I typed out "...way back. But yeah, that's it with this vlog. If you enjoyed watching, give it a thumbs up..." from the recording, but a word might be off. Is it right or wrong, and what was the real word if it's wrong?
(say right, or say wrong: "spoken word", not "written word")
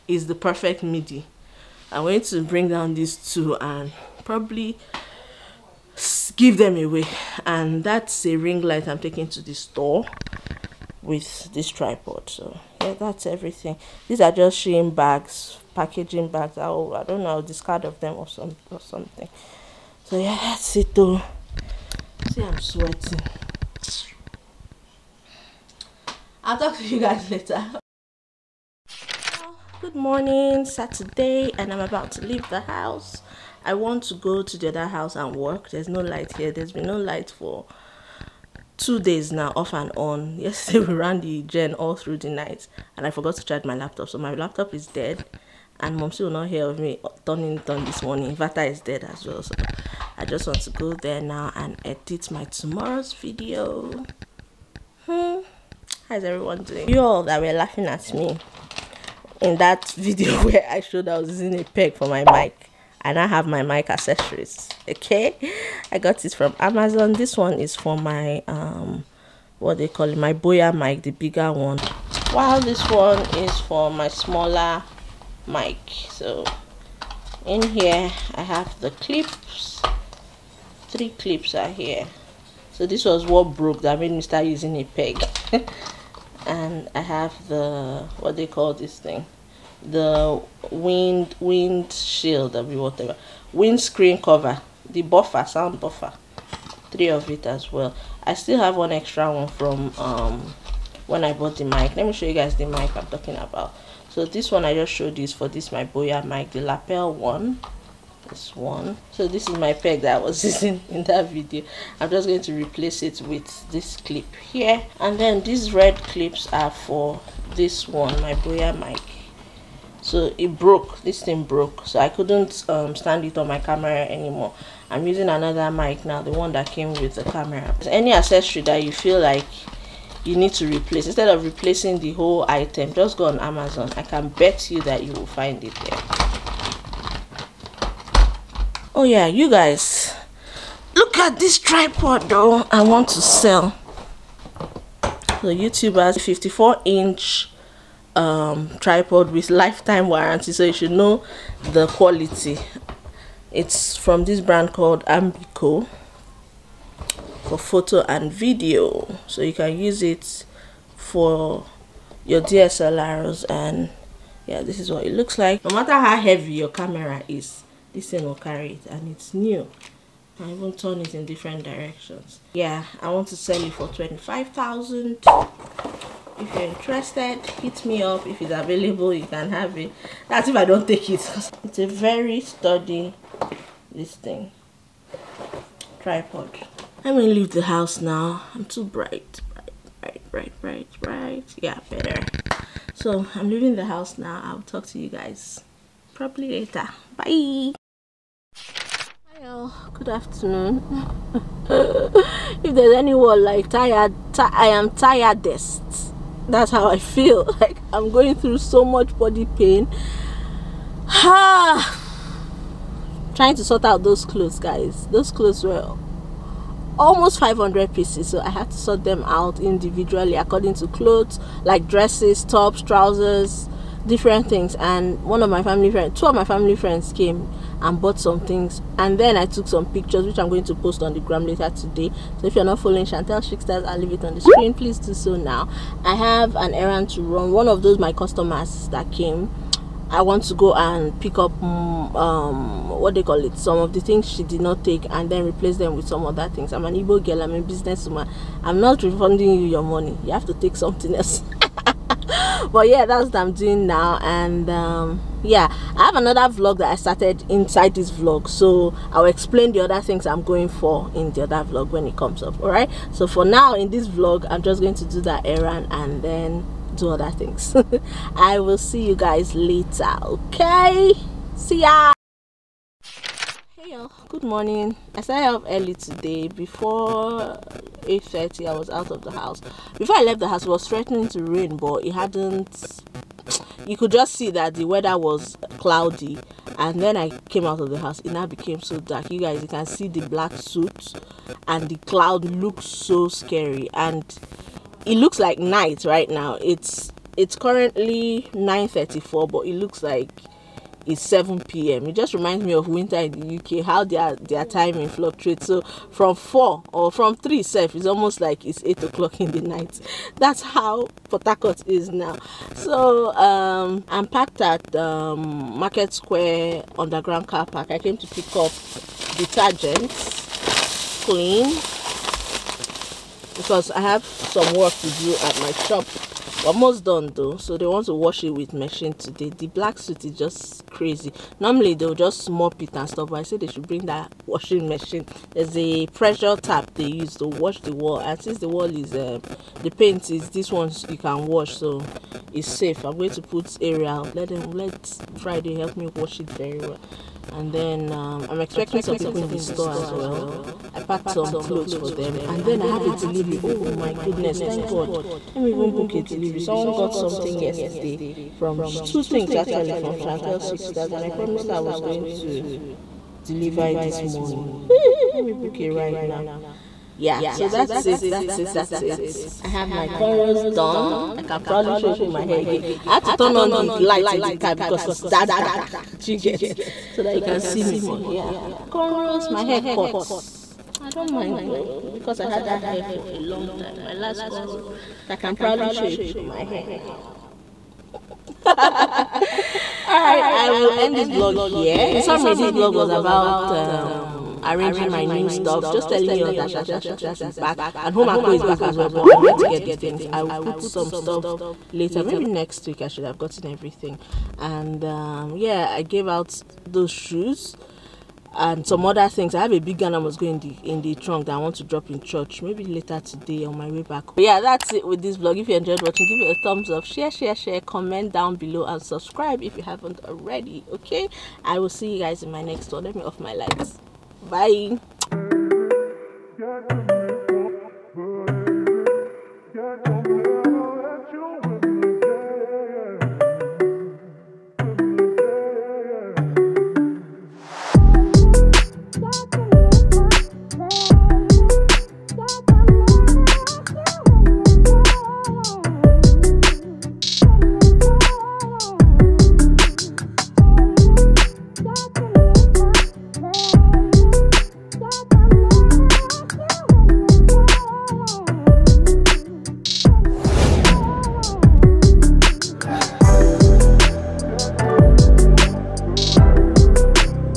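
right.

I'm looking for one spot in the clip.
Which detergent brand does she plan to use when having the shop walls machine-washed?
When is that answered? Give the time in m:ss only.
5:43.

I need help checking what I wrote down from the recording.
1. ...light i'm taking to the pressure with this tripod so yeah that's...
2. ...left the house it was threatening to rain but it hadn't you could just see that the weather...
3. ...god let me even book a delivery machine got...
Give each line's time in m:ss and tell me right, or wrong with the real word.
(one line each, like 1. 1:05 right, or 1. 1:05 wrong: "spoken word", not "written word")
1. 0:08 wrong: "store", not "pressure"
2. 4:40 right
3. 5:54 wrong: "someone", not "machine".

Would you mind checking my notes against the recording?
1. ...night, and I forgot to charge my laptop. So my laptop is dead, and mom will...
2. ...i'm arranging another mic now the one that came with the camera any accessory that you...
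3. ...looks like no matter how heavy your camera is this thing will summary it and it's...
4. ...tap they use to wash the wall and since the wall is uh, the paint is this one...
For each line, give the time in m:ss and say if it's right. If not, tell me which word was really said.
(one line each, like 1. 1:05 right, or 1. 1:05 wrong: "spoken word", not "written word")
1. 0:42 right
2. 2:04 wrong: "using", not "arranging"
3. 2:45 wrong: "carry", not "summary"
4. 5:36 right.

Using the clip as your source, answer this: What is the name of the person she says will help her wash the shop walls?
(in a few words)
Friday.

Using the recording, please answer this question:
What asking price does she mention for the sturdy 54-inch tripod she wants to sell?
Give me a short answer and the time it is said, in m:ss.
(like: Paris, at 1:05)
25,000, at 2:53.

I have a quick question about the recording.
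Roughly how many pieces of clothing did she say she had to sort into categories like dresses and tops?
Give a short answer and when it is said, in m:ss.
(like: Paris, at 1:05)
500, at 3:37.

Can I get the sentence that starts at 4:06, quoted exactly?
I'm an Igbo girl, I'm a businesswoman.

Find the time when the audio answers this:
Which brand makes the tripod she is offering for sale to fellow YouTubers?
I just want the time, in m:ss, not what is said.
2:35.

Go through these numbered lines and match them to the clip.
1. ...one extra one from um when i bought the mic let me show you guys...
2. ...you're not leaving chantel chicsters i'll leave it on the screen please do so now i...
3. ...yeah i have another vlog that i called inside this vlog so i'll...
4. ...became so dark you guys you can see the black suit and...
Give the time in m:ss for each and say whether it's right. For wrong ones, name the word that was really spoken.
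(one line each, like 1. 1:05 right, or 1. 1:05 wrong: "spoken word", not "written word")
1. 1:38 right
2. 3:52 wrong: "following", not "leaving"
3. 4:15 wrong: "started", not "called"
4. 4:48 right.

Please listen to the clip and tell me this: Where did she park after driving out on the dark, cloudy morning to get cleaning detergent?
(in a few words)
Market Square underground car park.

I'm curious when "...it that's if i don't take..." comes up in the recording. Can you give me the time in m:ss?
2:59.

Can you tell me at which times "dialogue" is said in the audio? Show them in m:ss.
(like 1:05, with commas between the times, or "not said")
not said.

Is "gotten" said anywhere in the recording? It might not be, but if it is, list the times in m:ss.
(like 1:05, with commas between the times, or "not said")
6:43.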